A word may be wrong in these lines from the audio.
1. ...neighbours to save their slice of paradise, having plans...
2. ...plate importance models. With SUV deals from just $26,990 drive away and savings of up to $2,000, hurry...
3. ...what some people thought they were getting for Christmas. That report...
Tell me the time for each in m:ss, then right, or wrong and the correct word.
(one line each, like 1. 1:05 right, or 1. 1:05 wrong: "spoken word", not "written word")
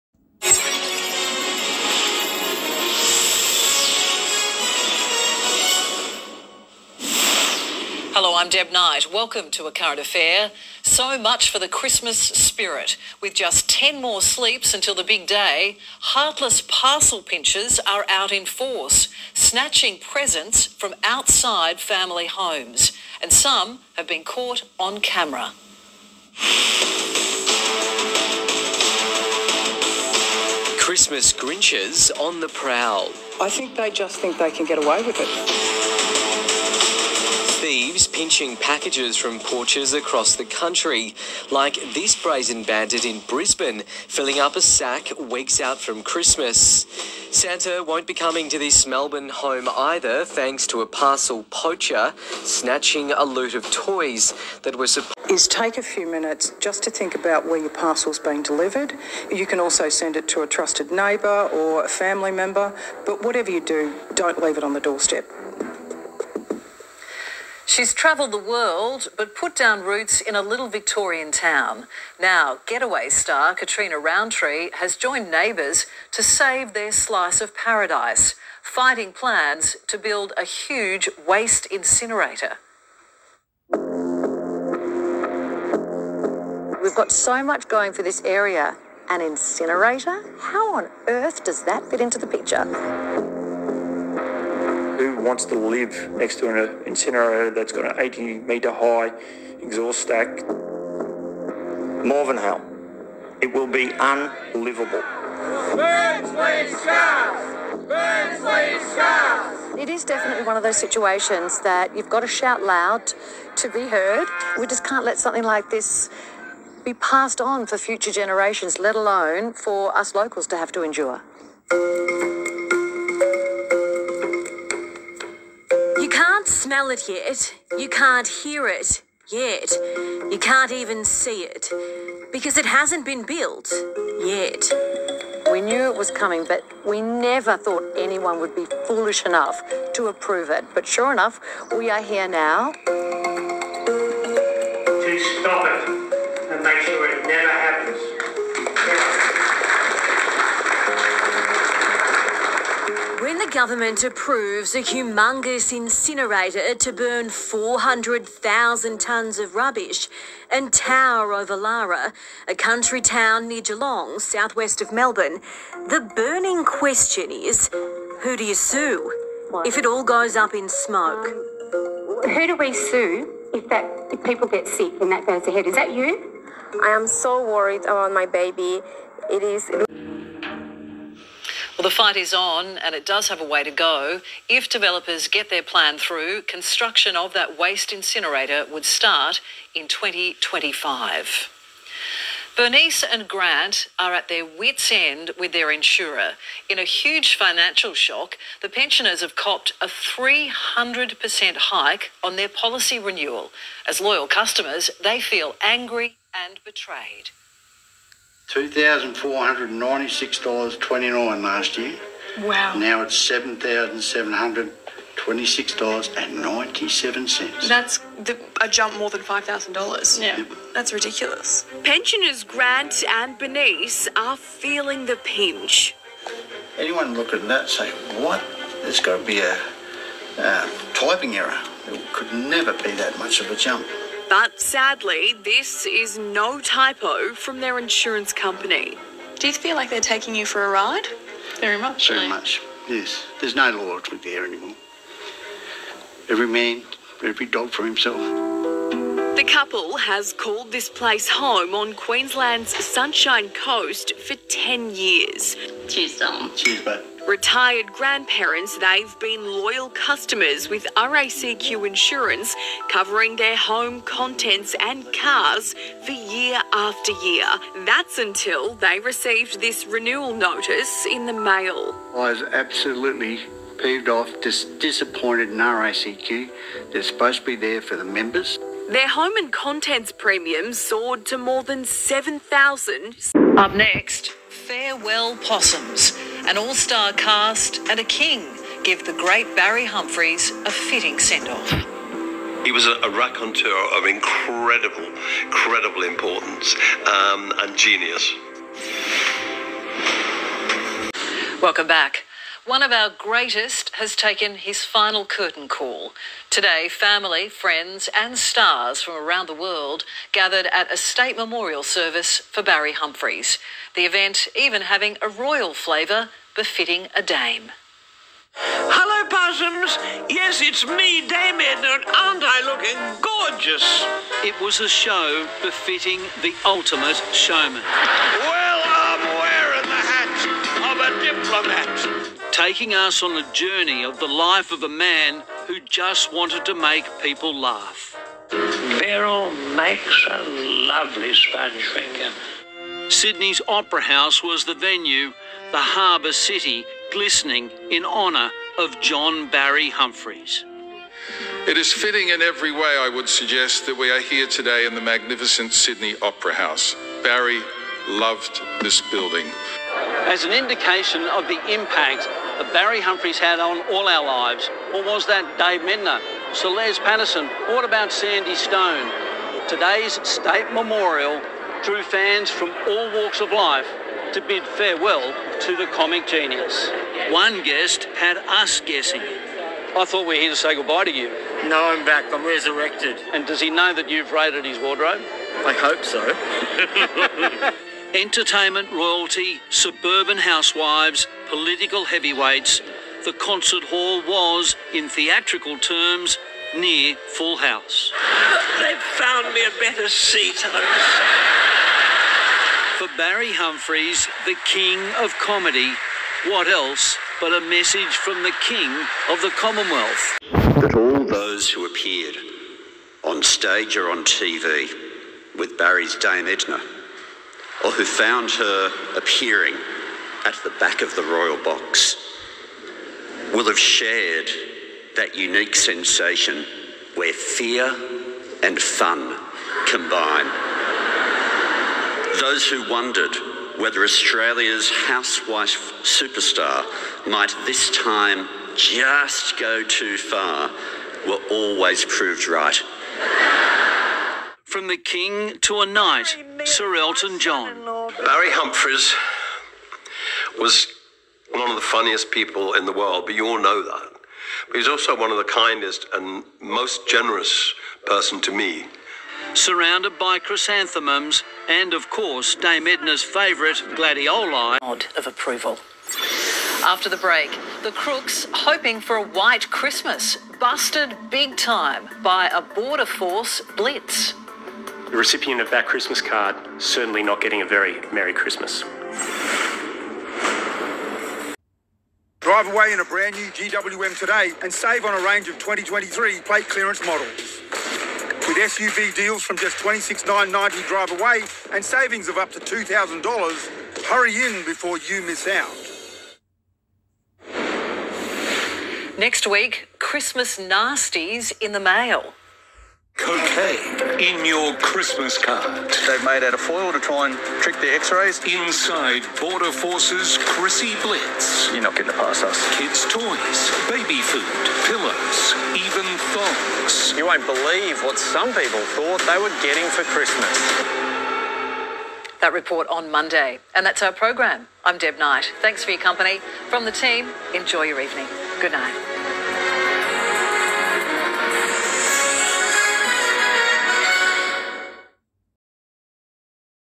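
1. 1:15 wrong: "fighting", not "having"
2. 8:06 wrong: "clearance", not "importance"
3. 8:38 right.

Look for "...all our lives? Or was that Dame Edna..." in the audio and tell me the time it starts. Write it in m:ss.
6:03.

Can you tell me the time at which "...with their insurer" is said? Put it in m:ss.
3:15.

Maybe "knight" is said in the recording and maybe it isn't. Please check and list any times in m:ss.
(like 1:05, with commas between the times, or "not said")
0:08, 7:25, 8:45.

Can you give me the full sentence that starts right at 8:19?
Next week, Christmas nasties in the mail.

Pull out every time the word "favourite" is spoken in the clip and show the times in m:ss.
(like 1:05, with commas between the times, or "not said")
7:43.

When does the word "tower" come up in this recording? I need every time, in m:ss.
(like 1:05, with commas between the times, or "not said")
2:40.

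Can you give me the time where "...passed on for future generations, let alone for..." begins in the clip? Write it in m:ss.
1:56.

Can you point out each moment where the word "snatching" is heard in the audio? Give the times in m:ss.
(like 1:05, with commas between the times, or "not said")
0:19, 0:52.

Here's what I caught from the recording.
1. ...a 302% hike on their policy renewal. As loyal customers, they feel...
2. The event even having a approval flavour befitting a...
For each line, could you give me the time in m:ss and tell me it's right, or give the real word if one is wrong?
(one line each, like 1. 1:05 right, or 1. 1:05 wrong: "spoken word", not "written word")
1. 3:19 wrong: "300", not "302"
2. 5:13 wrong: "royal", not "approval".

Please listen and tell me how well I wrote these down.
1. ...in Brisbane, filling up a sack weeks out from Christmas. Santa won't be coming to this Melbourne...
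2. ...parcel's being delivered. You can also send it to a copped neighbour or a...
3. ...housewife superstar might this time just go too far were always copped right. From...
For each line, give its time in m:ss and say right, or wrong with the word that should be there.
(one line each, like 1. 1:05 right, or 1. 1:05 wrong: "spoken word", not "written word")
1. 0:43 right
2. 0:57 wrong: "trusted", not "copped"
3. 7:14 wrong: "proved", not "copped".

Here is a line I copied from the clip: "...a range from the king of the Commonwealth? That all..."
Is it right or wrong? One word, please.
wrong.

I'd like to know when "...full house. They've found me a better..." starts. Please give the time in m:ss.
6:37.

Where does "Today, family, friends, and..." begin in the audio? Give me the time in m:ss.
5:06.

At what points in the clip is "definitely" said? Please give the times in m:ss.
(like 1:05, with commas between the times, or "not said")
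1:50.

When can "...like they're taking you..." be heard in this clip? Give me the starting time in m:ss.
3:59.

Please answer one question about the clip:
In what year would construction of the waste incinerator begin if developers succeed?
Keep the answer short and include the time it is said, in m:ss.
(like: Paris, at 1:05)
2025, at 3:09.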